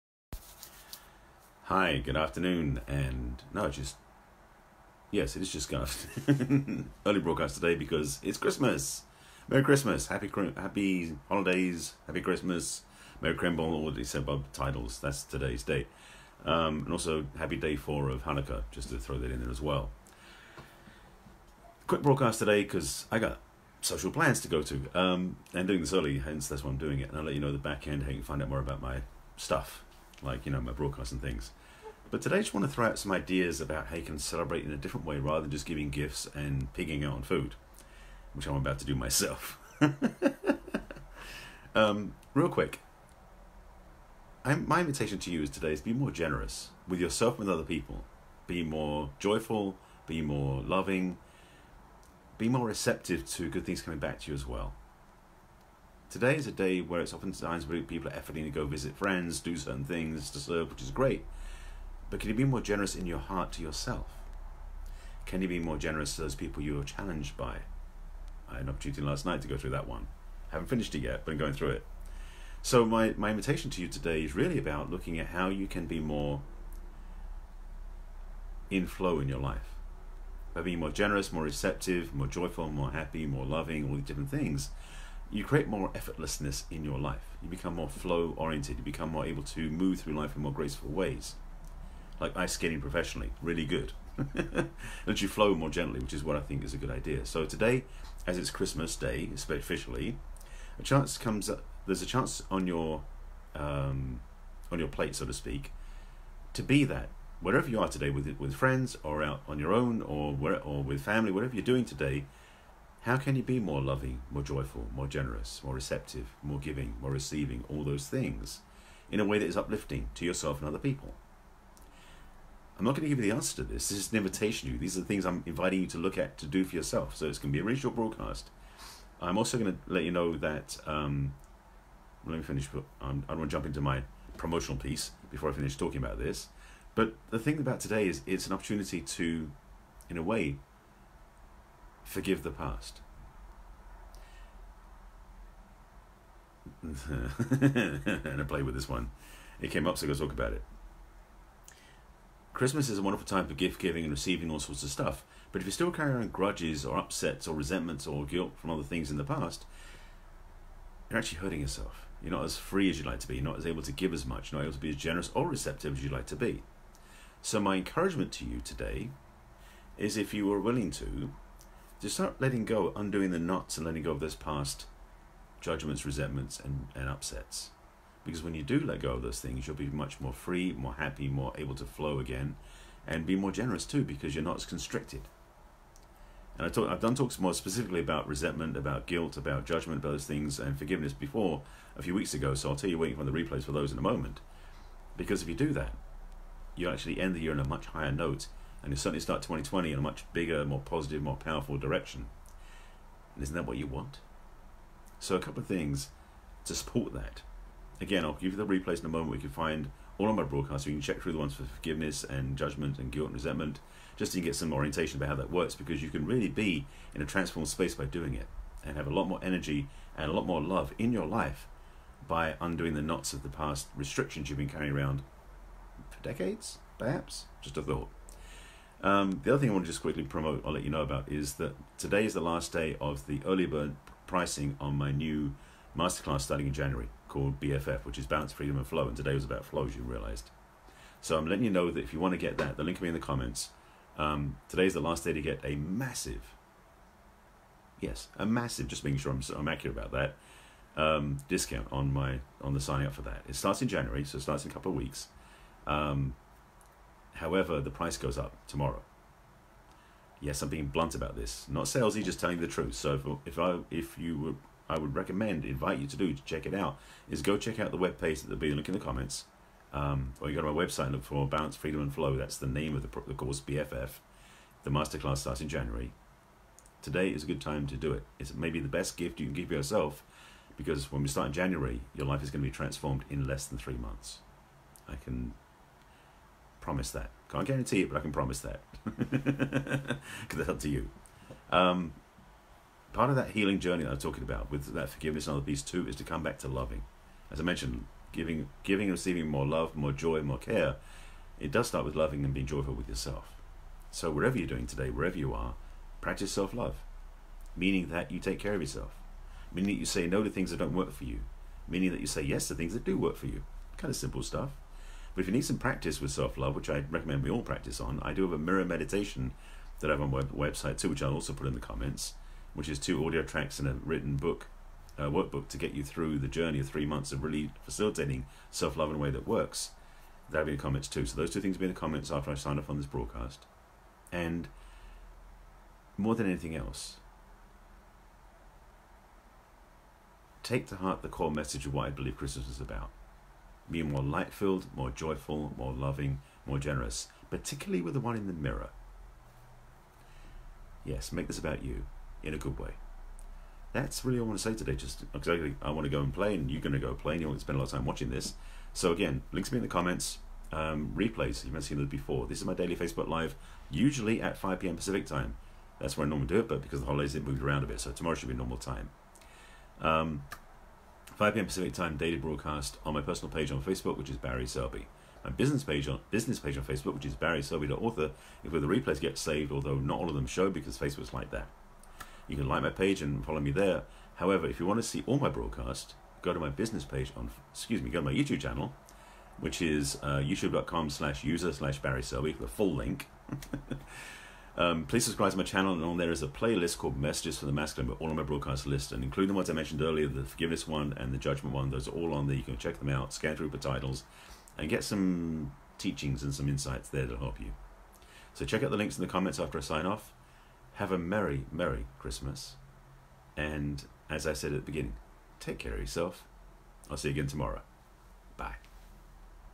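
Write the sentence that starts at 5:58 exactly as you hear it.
So again, links me in the comments.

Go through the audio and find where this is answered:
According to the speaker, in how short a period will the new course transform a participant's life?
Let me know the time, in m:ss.
4:43.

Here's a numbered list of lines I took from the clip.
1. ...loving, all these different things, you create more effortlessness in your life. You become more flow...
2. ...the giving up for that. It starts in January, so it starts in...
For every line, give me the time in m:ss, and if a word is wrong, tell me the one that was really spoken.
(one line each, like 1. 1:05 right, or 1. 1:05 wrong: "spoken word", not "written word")
1. 1:23 right
2. 4:12 wrong: "signing", not "giving".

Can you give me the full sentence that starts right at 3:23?
And isn't that what you want?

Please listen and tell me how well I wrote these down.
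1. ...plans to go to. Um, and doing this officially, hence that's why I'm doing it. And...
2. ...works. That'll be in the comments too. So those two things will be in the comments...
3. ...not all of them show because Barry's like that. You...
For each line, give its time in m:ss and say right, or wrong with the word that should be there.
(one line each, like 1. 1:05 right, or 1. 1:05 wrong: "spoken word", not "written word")
1. 0:24 wrong: "early", not "officially"
2. 5:29 right
3. 6:19 wrong: "Facebook", not "Barry".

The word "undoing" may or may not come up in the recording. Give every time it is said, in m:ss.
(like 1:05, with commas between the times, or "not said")
2:52, 3:42.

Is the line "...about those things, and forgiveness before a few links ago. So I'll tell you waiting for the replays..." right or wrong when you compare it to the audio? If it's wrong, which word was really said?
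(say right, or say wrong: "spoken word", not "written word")
wrong: "weeks", not "links".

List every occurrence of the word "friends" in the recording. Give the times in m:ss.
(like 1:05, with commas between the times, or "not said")
0:58, 1:48.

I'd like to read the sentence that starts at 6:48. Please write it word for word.
So check out the links in the comments after I sign off.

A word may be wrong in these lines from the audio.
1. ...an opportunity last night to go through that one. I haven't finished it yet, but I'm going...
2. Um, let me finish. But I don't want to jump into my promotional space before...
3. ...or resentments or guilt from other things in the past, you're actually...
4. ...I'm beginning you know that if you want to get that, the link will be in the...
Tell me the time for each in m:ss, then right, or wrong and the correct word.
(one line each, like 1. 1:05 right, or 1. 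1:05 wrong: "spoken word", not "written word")
1. 1:08 right
2. 2:10 wrong: "piece", not "space"
3. 2:37 right
4. 4:01 wrong: "letting", not "beginning".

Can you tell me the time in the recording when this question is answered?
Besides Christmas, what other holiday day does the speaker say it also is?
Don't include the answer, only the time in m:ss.
0:17.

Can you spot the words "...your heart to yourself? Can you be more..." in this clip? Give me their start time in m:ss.
1:03.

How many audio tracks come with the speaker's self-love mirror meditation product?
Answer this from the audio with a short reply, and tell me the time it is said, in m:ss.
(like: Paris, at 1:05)
2, at 5:22.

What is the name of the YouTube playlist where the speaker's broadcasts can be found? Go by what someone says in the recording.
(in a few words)
Messages From the Masculine.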